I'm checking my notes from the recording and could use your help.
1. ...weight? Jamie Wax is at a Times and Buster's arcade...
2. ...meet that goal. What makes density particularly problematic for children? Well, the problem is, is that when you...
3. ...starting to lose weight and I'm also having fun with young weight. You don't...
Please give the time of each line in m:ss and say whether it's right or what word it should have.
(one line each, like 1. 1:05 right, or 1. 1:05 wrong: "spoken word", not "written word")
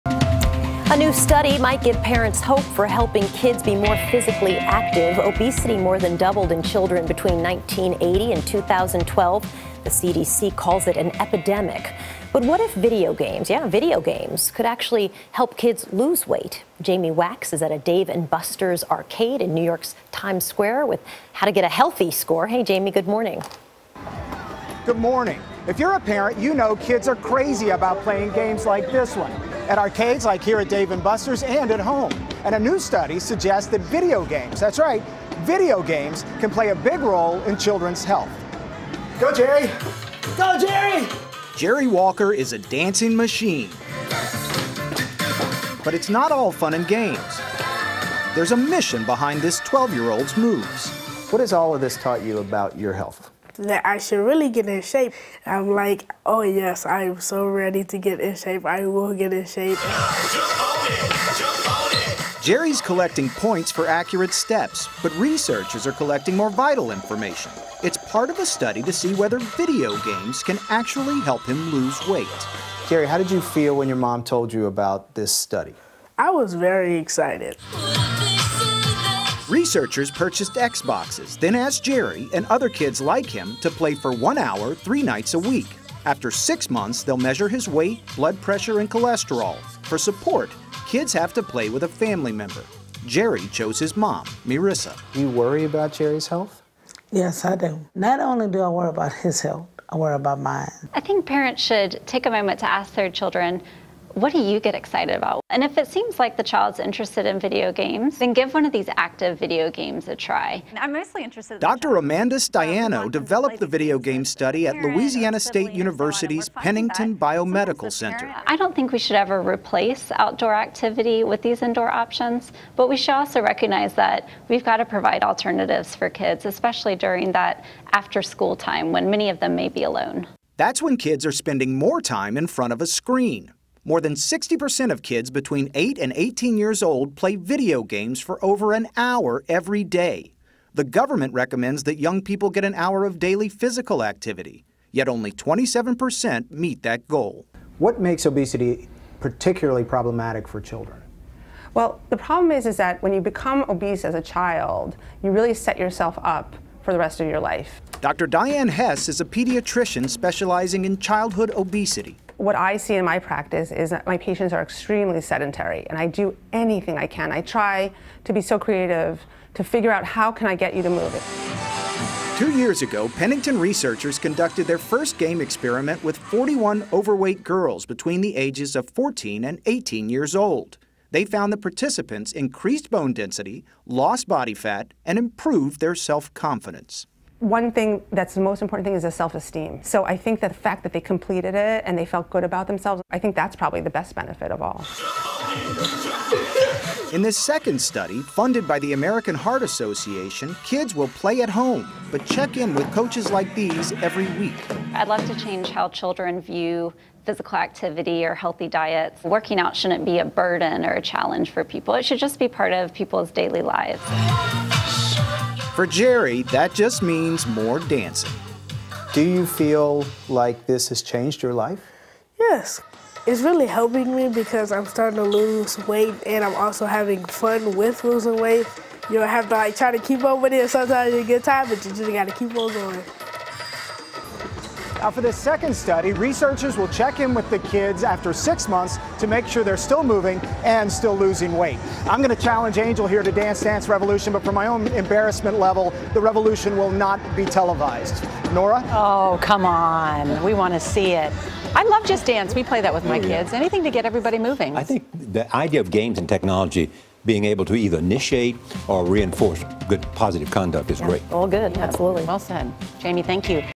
1. 0:16 wrong: "Dave", not "Times"
2. 2:26 wrong: "obesity", not "density"
3. 3:44 wrong: "losing", not "young".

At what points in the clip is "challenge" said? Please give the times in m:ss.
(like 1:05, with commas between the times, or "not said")
3:31, 4:02.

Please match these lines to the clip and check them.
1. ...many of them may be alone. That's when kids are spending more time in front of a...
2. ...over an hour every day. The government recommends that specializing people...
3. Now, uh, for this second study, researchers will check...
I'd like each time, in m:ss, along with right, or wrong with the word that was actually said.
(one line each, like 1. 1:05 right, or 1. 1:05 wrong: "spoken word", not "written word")
1. 2:09 right
2. 2:18 wrong: "young", not "specializing"
3. 3:55 right.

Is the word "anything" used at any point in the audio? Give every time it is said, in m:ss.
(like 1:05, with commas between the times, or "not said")
2:46, 4:13.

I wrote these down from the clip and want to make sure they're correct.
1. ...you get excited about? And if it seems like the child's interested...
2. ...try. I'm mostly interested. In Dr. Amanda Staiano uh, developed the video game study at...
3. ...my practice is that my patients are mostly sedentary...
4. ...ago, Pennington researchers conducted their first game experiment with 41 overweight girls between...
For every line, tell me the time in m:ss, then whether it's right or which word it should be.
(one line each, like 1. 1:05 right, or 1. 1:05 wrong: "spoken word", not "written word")
1. 1:44 right
2. 1:50 right
3. 2:43 wrong: "extremely", not "mostly"
4. 2:52 right.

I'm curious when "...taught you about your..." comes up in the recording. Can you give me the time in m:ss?
0:51.